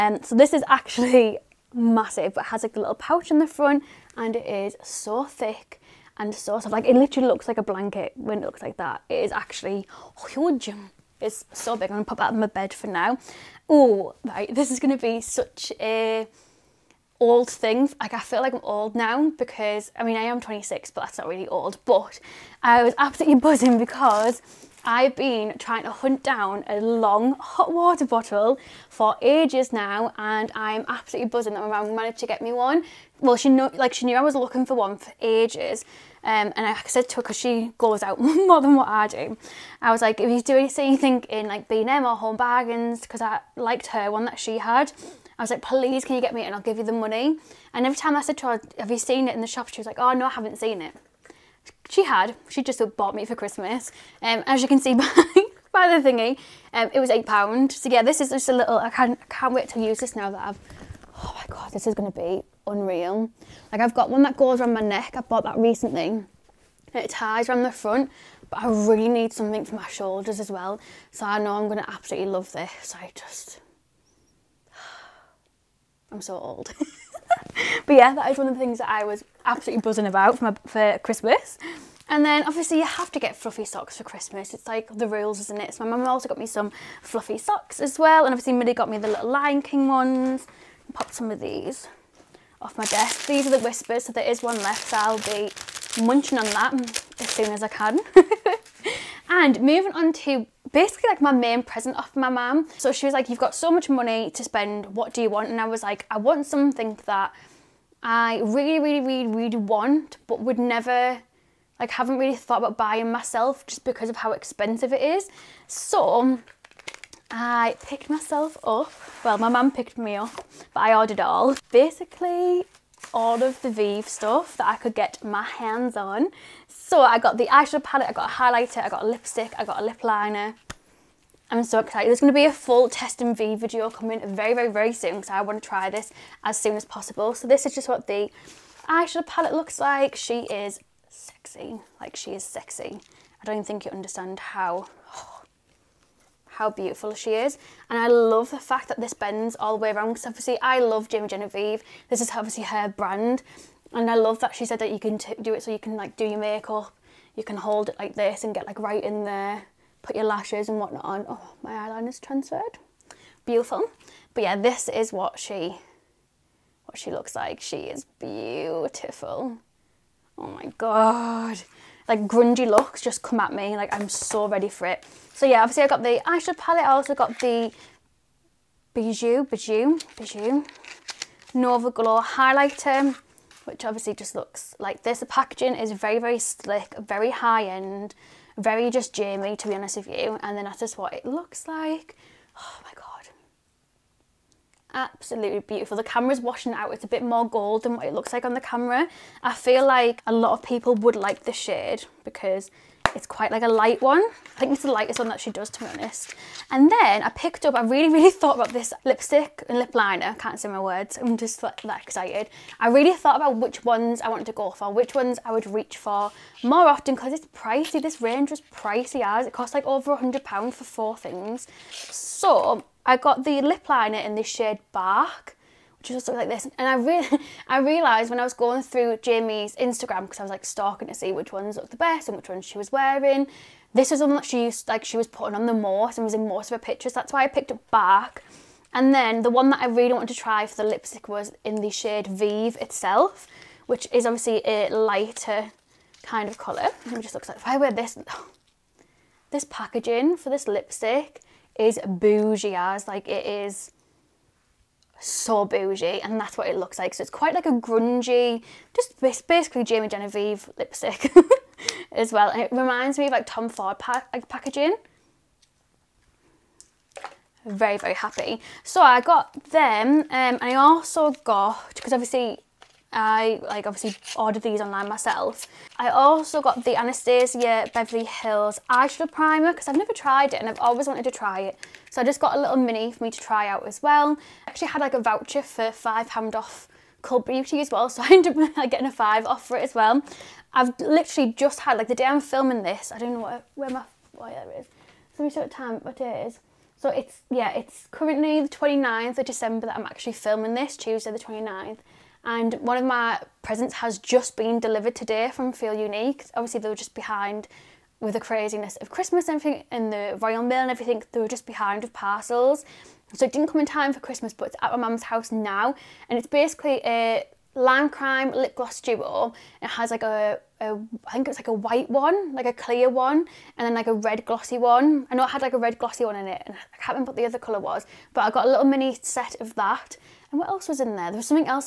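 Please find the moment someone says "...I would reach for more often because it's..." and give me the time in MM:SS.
03:35.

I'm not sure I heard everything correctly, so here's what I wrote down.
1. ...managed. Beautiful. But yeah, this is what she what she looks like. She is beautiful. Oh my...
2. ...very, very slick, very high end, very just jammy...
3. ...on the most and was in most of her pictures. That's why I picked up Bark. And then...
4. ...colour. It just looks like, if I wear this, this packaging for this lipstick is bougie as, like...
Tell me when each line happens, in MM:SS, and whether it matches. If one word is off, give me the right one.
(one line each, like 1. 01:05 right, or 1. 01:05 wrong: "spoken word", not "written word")
1. 02:42 wrong: "transferred", not "managed"
2. 03:05 right
3. 03:55 right
4. 04:06 right.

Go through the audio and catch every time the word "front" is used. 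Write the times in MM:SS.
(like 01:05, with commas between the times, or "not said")
00:03, 01:07.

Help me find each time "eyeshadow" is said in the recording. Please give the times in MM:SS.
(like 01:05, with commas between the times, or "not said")
02:07, 02:18, 02:56, 04:38.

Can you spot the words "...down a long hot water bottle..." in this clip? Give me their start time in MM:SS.
00:26.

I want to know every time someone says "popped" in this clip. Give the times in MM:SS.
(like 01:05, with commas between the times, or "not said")
01:30.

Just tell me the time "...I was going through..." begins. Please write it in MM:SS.
03:48.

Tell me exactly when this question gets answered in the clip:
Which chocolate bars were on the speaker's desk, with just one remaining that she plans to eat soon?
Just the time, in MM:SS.
01:33.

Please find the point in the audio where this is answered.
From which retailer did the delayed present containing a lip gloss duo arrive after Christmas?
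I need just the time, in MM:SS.
05:05.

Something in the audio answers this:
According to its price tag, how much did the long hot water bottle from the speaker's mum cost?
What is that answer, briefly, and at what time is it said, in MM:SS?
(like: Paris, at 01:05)
£8, at 00:57.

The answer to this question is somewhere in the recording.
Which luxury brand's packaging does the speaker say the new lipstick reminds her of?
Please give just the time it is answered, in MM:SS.
04:23.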